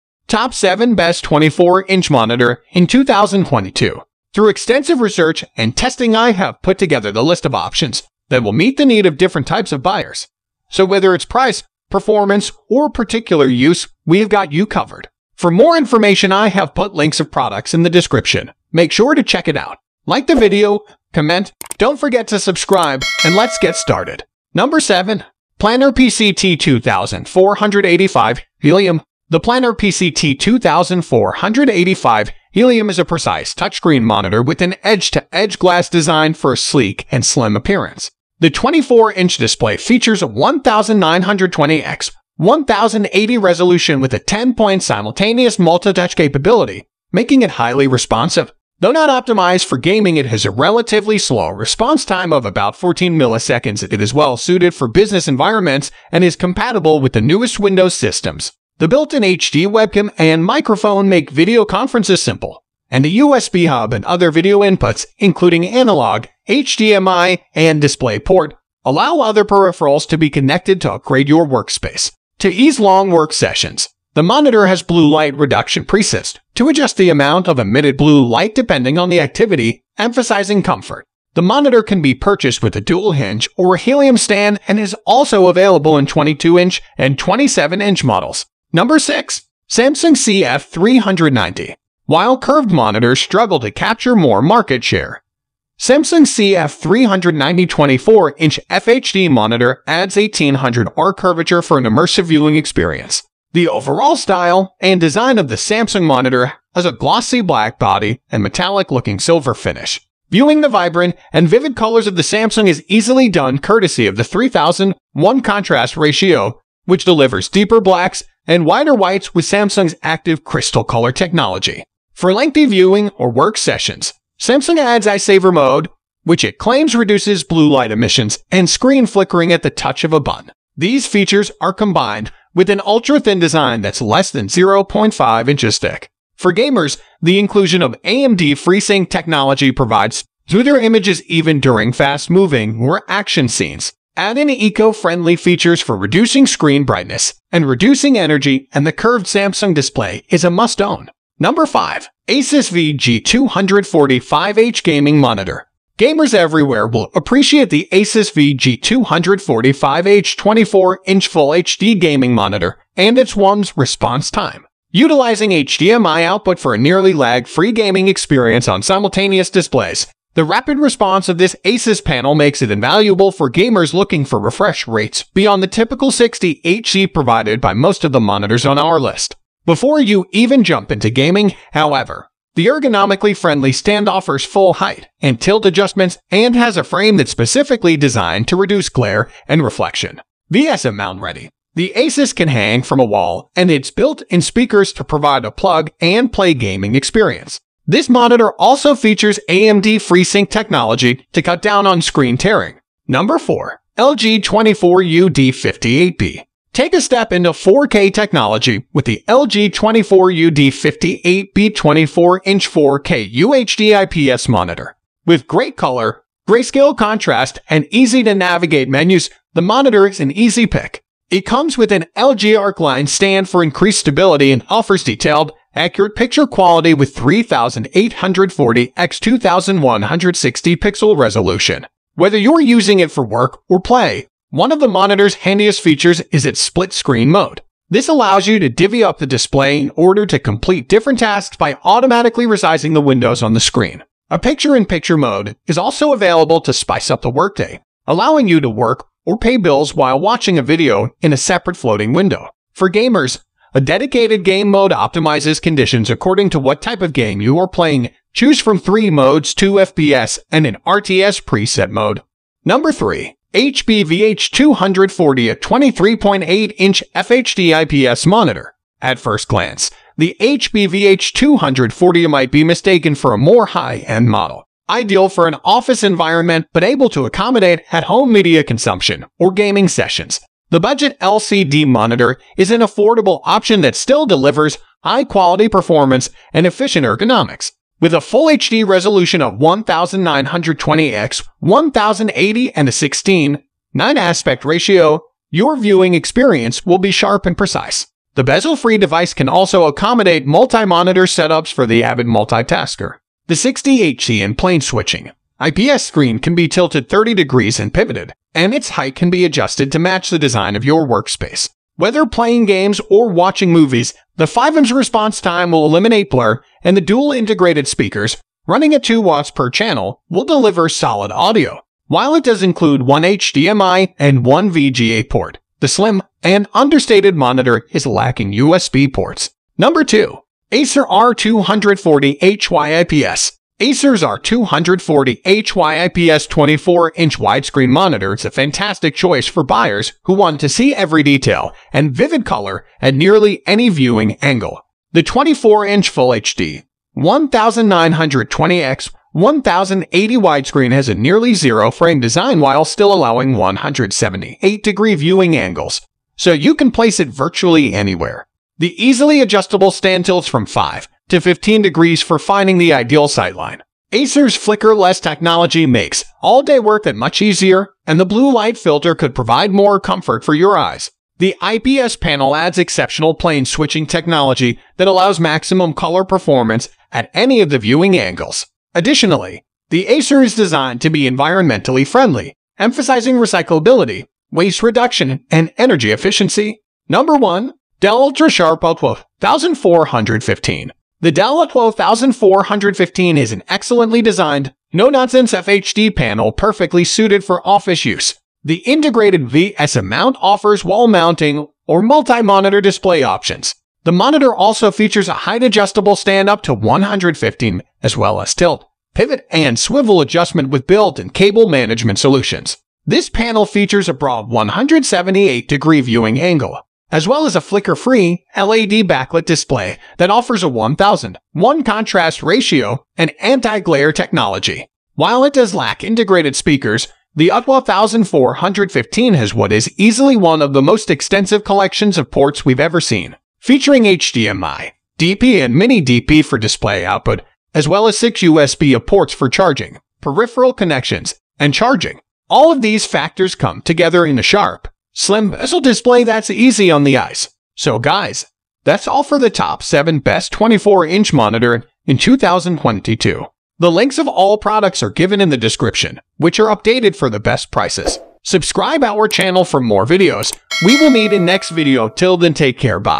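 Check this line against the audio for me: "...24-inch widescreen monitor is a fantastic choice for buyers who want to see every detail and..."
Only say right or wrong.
right.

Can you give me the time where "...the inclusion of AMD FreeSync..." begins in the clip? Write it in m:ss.
2:17.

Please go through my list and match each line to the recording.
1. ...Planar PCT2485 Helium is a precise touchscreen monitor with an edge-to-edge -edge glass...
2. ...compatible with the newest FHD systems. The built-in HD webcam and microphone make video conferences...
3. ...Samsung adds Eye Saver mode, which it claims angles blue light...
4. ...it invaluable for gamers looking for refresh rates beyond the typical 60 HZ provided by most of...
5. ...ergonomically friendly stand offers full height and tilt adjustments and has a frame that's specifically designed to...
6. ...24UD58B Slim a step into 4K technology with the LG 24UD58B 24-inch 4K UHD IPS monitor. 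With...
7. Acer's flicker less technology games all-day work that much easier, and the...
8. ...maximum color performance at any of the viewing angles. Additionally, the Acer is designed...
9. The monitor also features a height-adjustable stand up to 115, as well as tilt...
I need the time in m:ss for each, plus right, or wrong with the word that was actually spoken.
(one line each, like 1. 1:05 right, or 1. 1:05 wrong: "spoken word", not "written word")
1. 0:29 right
2. 0:56 wrong: "Windows", not "FHD"
3. 2:04 wrong: "reduces", not "angles"
4. 2:52 right
5. 3:02 right
6. 3:24 wrong: "Take", not "Slim"
7. 6:04 wrong: "makes", not "games"
8. 6:15 right
9. 6:44 right.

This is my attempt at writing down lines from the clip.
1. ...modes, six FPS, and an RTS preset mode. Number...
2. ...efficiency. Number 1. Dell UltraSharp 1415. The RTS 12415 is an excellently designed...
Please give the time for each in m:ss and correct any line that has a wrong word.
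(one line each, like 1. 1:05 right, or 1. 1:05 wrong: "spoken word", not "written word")
1. 4:19 wrong: "two", not "six"
2. 6:26 wrong: "Dalla", not "RTS".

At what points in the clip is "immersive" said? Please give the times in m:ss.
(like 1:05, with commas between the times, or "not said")
1:41.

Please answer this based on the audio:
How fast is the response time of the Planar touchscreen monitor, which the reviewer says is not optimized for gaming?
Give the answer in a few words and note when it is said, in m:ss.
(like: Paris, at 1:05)
14 milliseconds, at 0:52.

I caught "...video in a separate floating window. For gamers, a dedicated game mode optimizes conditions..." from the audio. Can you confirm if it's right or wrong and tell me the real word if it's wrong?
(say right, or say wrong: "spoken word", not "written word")
right.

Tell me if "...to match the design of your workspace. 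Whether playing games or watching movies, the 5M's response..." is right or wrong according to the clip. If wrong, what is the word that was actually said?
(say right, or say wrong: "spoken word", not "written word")
right.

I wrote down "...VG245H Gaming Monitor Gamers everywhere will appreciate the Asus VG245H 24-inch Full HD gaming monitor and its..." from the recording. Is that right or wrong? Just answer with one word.
right.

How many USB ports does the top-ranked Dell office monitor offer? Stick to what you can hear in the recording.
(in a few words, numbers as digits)
6.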